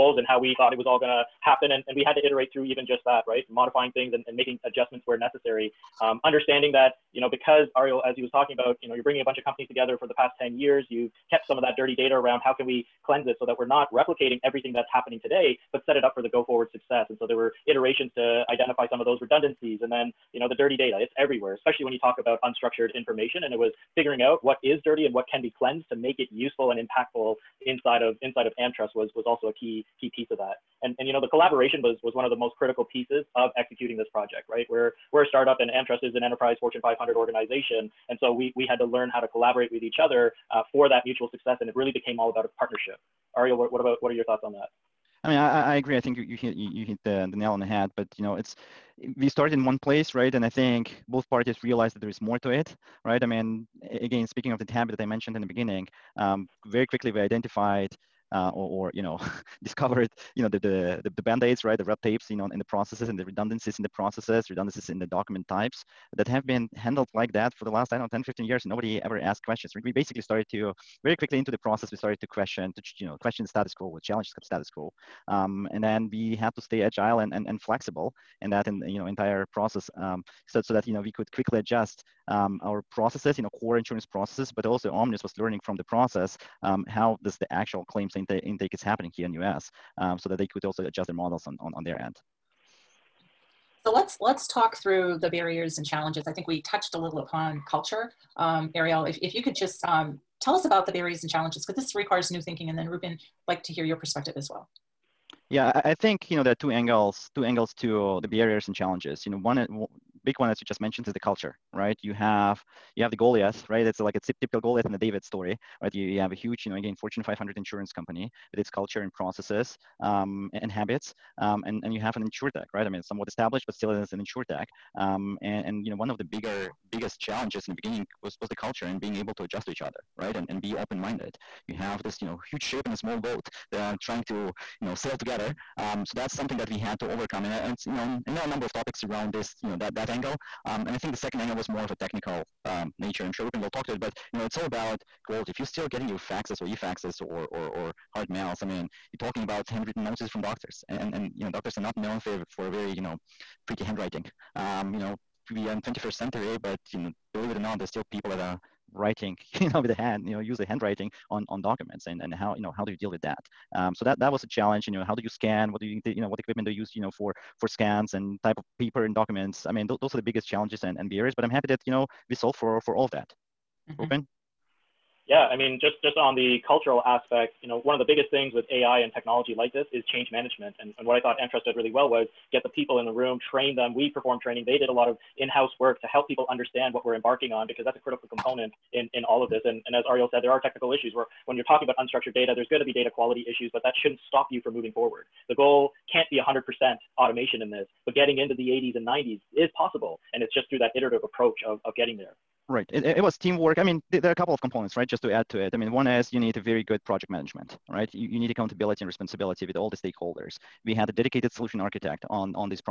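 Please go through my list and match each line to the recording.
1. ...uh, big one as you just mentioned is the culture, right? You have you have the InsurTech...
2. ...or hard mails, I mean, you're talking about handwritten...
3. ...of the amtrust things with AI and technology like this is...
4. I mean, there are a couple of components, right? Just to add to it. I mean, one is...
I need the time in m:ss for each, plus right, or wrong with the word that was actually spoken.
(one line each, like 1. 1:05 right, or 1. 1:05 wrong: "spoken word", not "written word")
1. 1:49 wrong: "Goliath", not "InsurTech"
2. 2:27 right
3. 2:57 wrong: "biggest", not "amtrust"
4. 3:23 right.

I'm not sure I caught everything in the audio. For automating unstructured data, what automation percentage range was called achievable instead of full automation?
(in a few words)
80s and 90s.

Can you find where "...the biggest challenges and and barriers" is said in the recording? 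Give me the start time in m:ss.
2:50.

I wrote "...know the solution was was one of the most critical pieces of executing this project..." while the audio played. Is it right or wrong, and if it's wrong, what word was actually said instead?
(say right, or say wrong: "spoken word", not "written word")
wrong: "collaboration", not "solution".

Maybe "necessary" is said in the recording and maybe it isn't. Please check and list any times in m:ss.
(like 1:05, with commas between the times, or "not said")
0:05.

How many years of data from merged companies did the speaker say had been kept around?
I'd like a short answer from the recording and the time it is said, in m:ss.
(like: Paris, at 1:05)
10, at 0:10.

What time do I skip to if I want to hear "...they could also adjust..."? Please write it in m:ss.
1:30.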